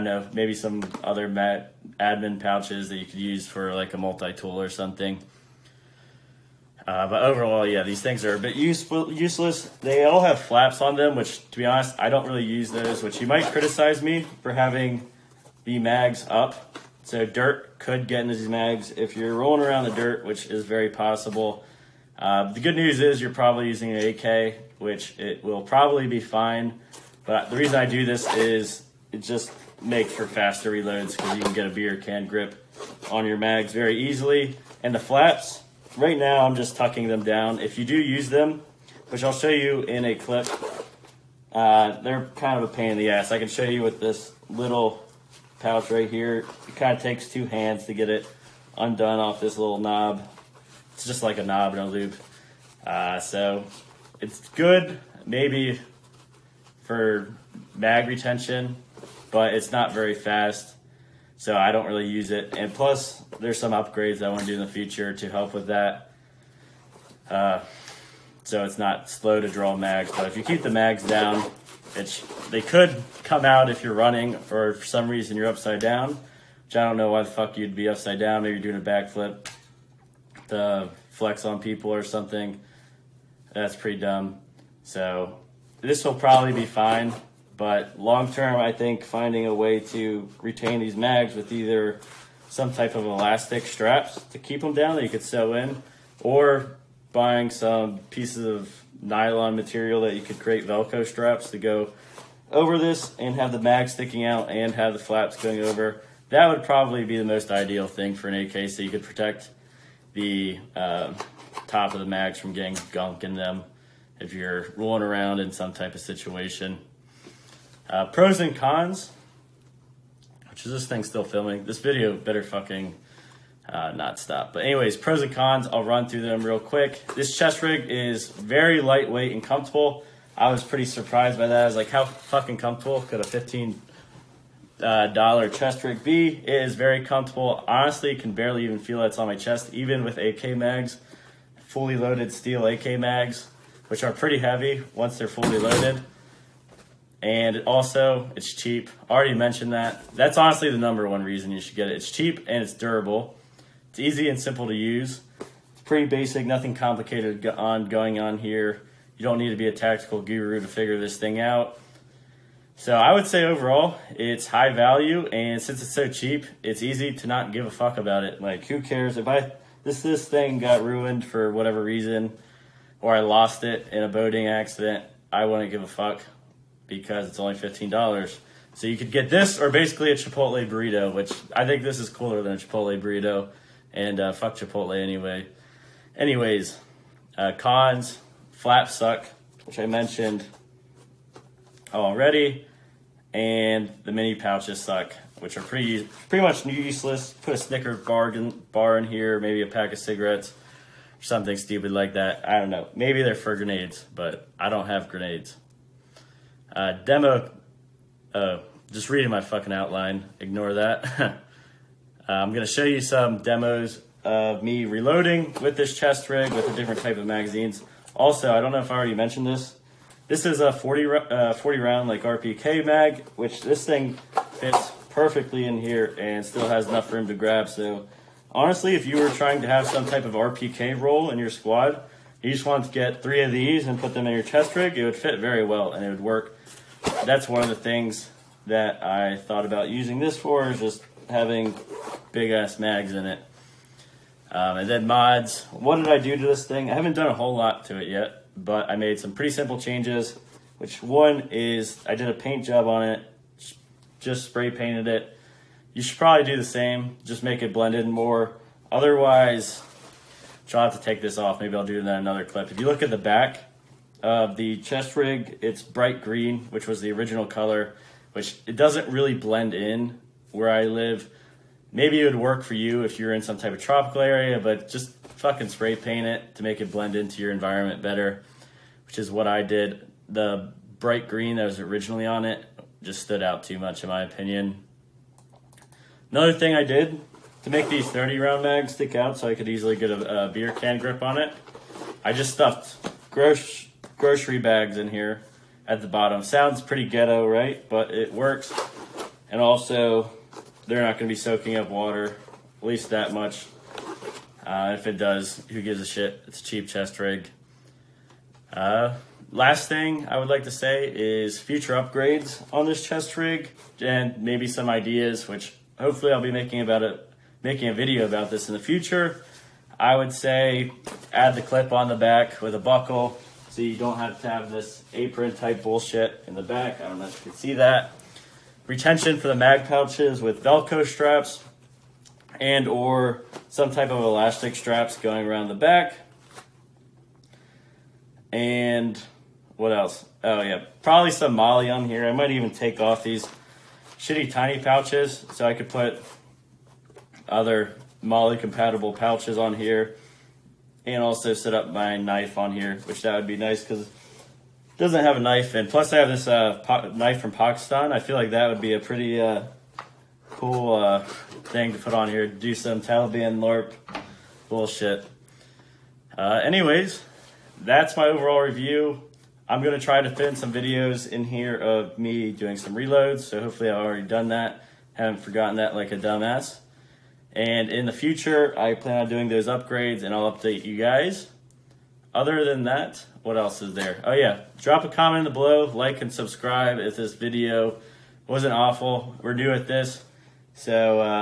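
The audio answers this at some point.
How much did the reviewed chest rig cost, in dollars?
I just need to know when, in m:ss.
2:13.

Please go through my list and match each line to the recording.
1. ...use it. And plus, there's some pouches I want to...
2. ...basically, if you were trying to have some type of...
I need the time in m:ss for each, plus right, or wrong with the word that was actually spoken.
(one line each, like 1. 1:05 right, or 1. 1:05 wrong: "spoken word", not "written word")
1. 1:02 wrong: "upgrades", not "pouches"
2. 3:48 wrong: "honestly", not "basically".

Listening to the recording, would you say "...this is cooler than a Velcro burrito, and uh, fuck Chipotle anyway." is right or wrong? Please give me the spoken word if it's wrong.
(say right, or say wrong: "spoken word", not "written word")
wrong: "Chipotle", not "Velcro".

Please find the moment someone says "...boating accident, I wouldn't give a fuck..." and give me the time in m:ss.
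2:54.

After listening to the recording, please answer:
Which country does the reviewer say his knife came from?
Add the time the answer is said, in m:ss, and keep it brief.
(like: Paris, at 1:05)
Pakistan, at 5:57.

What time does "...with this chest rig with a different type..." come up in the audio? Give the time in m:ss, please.
3:35.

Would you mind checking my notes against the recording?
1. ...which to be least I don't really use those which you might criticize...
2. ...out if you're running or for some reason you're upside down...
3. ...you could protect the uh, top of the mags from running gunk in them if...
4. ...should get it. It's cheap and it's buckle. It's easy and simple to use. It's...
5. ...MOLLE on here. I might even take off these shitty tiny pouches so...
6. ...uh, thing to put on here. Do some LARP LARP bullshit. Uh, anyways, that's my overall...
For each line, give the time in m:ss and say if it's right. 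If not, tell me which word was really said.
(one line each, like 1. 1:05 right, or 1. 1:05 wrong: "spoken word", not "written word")
1. 0:11 wrong: "honest", not "least"
2. 1:13 right
3. 1:48 wrong: "getting", not "running"
4. 2:31 wrong: "durable", not "buckle"
5. 5:41 right
6. 6:00 wrong: "Taliban", not "LARP".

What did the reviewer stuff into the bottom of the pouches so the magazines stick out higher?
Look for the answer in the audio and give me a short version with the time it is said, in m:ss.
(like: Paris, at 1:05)
grocery bags, at 4:54.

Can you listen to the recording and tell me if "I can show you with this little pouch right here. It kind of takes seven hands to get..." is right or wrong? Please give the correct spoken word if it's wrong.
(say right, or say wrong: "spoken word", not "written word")
wrong: "two", not "seven".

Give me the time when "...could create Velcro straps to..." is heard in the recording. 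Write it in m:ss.
1:40.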